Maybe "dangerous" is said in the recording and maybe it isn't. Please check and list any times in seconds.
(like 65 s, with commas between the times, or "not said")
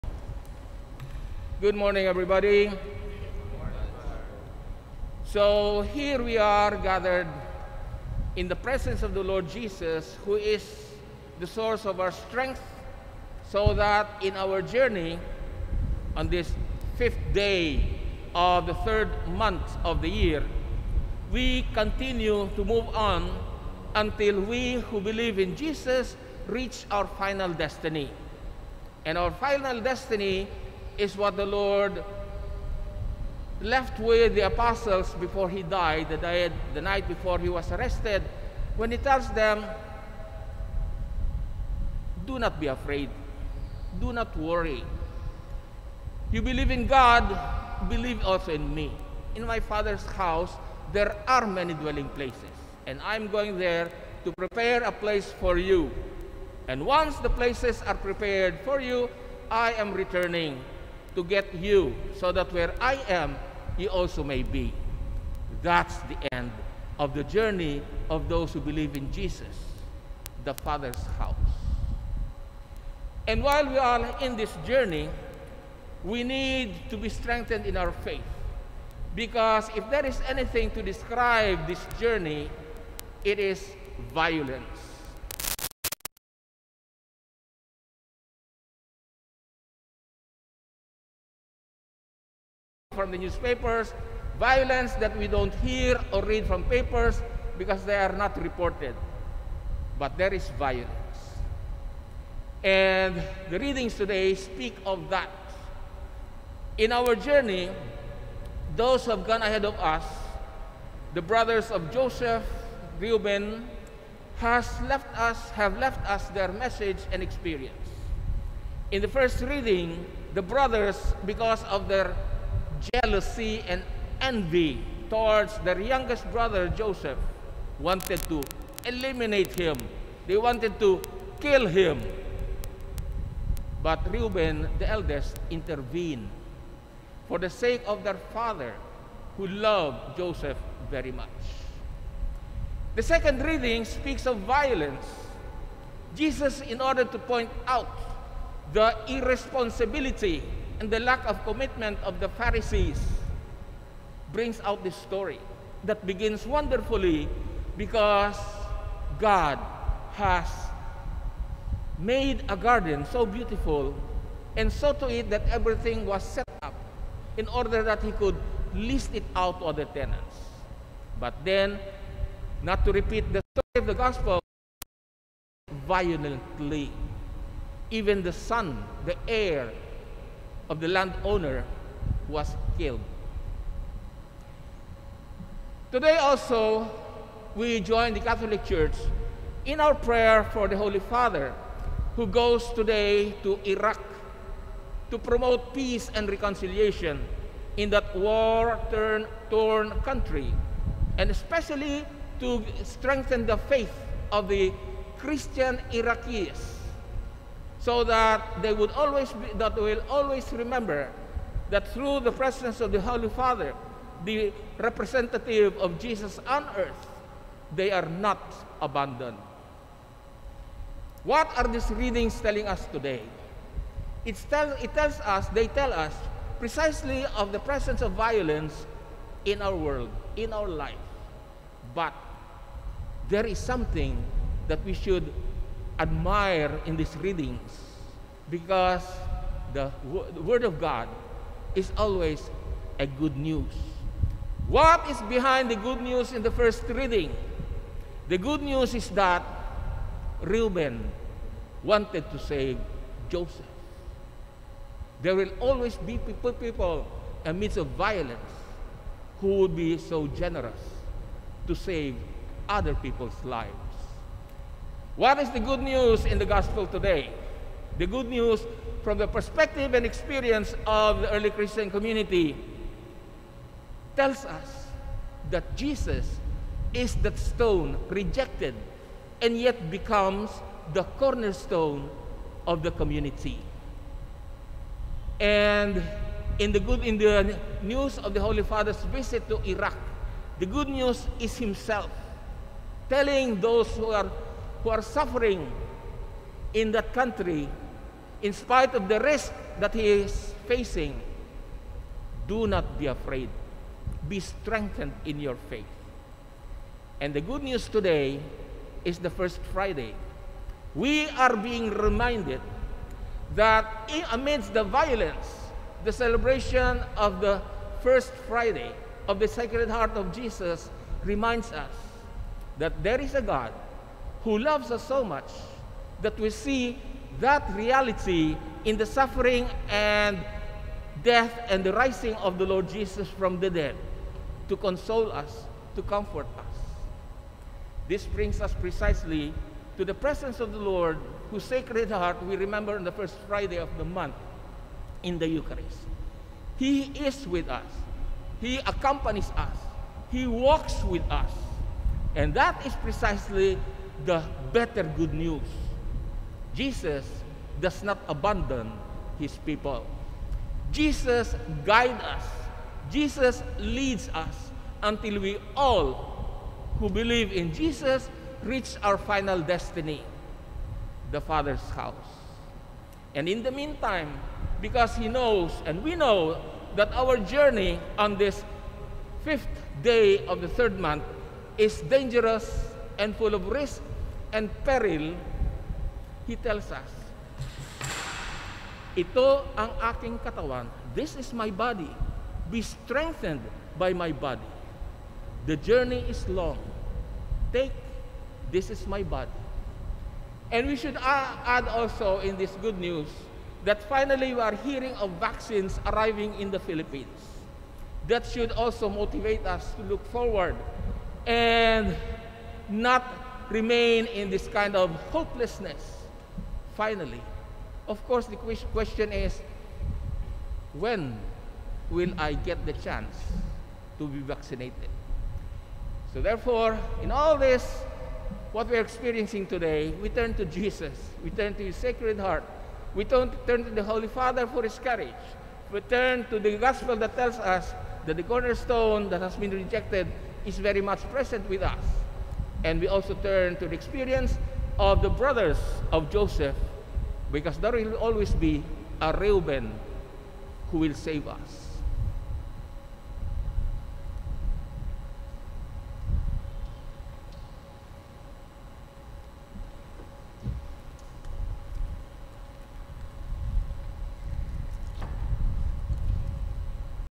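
382 s.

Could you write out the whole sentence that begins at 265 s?
What is the good news in the gospel today?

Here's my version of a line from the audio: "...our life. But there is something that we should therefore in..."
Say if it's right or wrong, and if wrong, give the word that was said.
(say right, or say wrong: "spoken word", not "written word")
wrong: "admire", not "therefore".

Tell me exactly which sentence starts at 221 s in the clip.
What are these readings telling us today?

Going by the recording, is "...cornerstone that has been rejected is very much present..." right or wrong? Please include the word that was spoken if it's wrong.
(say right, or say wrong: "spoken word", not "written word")
right.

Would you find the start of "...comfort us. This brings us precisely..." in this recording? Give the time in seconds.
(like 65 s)
336 s.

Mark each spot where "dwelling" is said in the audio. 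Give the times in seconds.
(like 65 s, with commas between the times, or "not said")
51 s.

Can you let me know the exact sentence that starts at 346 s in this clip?
He is with us, He accompanies us, He walks with us.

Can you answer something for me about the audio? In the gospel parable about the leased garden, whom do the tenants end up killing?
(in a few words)
the son, the heir.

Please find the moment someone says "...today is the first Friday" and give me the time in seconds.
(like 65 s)
307 s.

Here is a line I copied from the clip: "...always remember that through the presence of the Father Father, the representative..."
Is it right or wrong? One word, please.
wrong.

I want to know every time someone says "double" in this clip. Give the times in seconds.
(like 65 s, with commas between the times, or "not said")
not said.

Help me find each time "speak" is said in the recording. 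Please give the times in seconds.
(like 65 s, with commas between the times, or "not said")
104 s, 143 s.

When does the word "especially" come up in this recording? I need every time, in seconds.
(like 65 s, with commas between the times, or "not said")
201 s.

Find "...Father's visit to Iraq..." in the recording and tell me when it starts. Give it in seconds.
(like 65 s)
288 s.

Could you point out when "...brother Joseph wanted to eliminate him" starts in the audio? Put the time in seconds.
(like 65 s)
126 s.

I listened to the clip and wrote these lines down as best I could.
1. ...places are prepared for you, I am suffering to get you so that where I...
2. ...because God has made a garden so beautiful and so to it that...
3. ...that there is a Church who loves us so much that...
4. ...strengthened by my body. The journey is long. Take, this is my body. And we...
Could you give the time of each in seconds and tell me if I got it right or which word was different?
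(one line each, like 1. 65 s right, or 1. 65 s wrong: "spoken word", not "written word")
1. 57 s wrong: "returning", not "suffering"
2. 157 s right
3. 322 s wrong: "God", not "Church"
4. 392 s right.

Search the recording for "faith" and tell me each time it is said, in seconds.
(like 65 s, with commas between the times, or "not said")
77 s, 203 s, 305 s.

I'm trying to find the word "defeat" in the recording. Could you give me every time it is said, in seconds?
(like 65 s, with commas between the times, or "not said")
not said.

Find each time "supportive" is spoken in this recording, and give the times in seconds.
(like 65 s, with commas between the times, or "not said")
not said.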